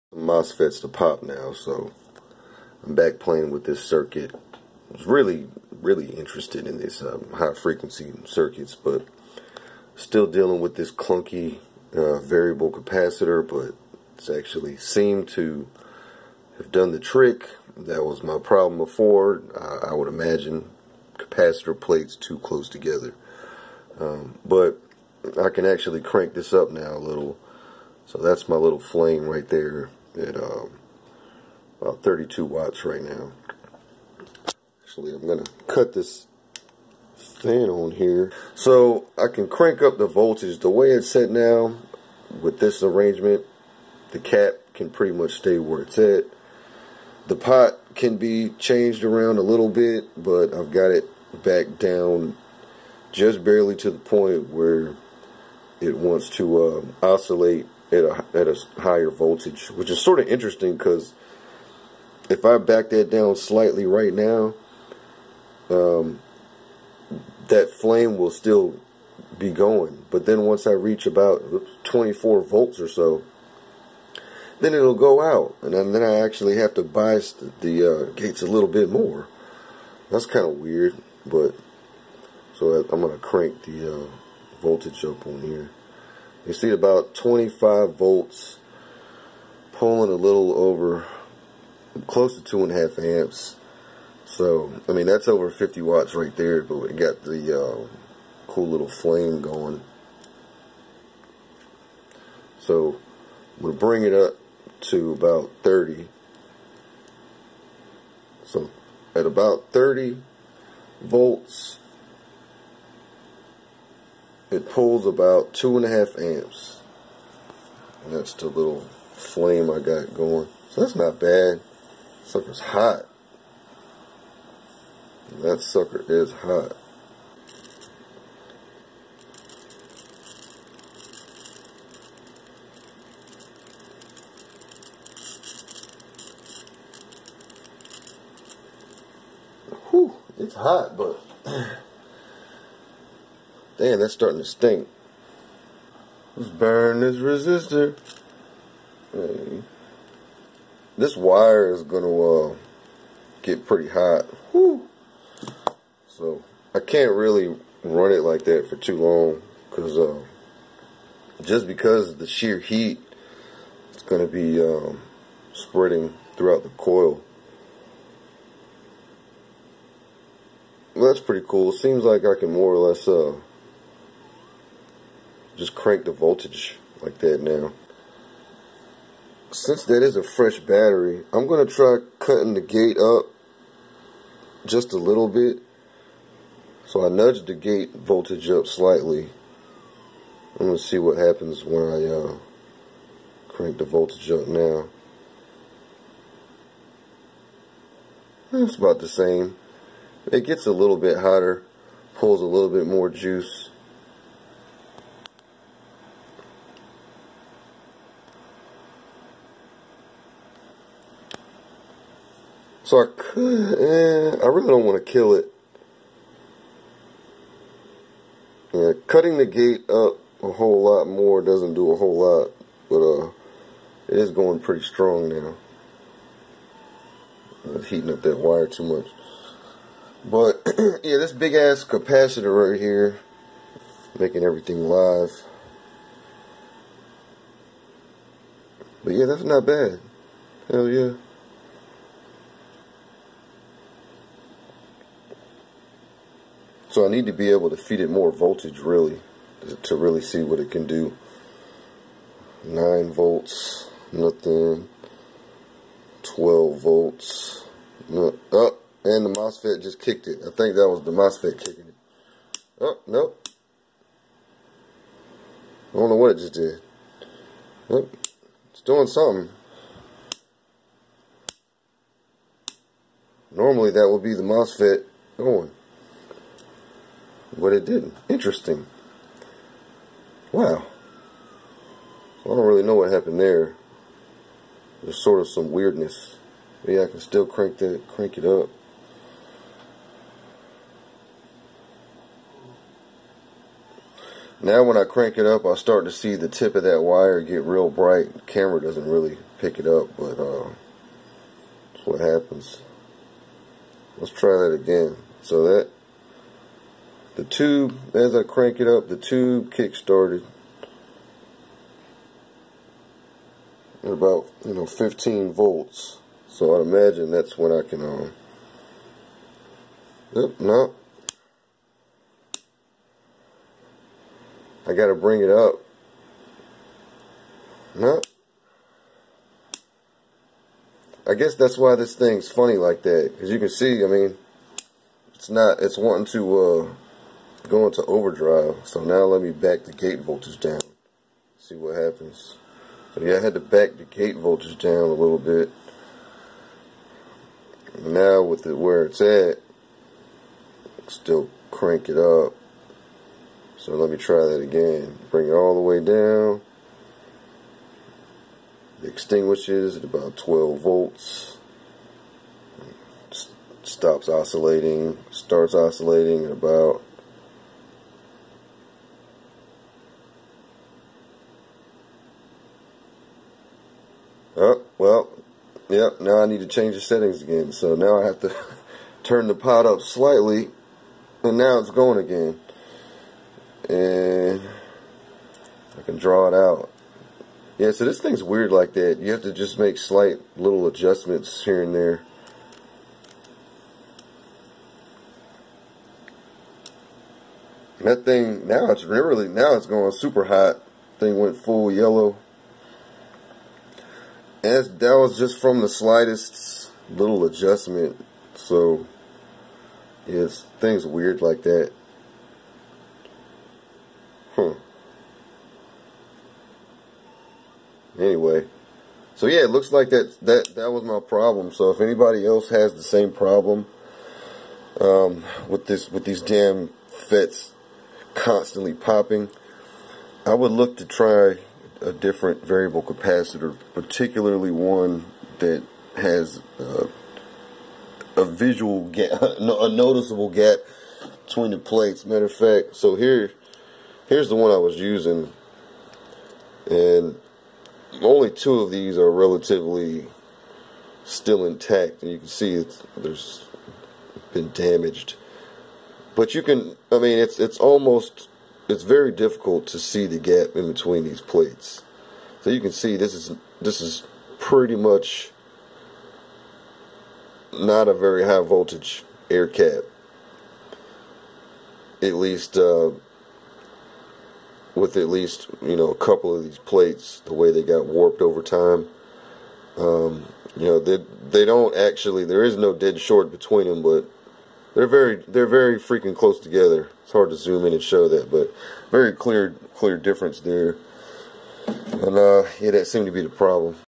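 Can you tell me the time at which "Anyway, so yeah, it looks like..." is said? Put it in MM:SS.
06:58.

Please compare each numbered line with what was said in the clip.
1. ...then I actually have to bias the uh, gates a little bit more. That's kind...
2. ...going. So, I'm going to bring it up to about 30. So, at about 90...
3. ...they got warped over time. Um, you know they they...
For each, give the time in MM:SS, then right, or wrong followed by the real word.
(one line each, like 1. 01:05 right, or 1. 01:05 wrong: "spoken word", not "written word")
1. 01:15 right
2. 01:39 wrong: "30", not "90"
3. 07:57 right.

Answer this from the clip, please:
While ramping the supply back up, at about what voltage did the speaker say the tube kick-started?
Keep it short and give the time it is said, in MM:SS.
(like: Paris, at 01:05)
15 volts, at 05:14.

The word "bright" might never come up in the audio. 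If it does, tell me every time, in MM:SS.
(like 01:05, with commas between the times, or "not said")
04:57.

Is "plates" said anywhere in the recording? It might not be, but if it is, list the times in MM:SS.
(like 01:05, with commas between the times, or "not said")
00:21, 07:21, 07:41, 07:56.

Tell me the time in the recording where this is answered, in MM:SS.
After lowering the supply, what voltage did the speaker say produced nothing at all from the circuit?
04:12.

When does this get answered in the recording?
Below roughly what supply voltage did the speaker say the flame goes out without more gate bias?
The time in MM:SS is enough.
01:11.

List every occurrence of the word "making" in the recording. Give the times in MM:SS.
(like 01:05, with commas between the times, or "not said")
03:54.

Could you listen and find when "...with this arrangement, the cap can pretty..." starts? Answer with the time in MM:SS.
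00:42.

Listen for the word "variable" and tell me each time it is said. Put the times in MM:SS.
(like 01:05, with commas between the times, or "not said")
00:12, 07:12.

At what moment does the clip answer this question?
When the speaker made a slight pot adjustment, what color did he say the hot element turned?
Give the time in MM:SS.
06:41.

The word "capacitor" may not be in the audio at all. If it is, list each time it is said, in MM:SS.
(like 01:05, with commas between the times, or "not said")
00:12, 00:21, 03:51, 07:13.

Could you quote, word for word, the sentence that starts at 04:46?
Yeah, I can still crank that, crank it up.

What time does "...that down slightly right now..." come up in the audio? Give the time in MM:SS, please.
01:02.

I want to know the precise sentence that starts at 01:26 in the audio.
You see about 25 volts pulling a little over close to two and a half amps.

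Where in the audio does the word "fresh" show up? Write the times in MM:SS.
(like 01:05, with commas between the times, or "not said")
03:00.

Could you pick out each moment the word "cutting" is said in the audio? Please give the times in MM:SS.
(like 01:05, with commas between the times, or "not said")
03:02, 03:39.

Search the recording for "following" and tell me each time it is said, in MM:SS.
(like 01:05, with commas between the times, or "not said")
not said.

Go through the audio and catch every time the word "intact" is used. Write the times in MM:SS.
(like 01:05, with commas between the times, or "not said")
07:31.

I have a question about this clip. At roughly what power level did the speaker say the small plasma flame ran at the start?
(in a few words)
32 watts.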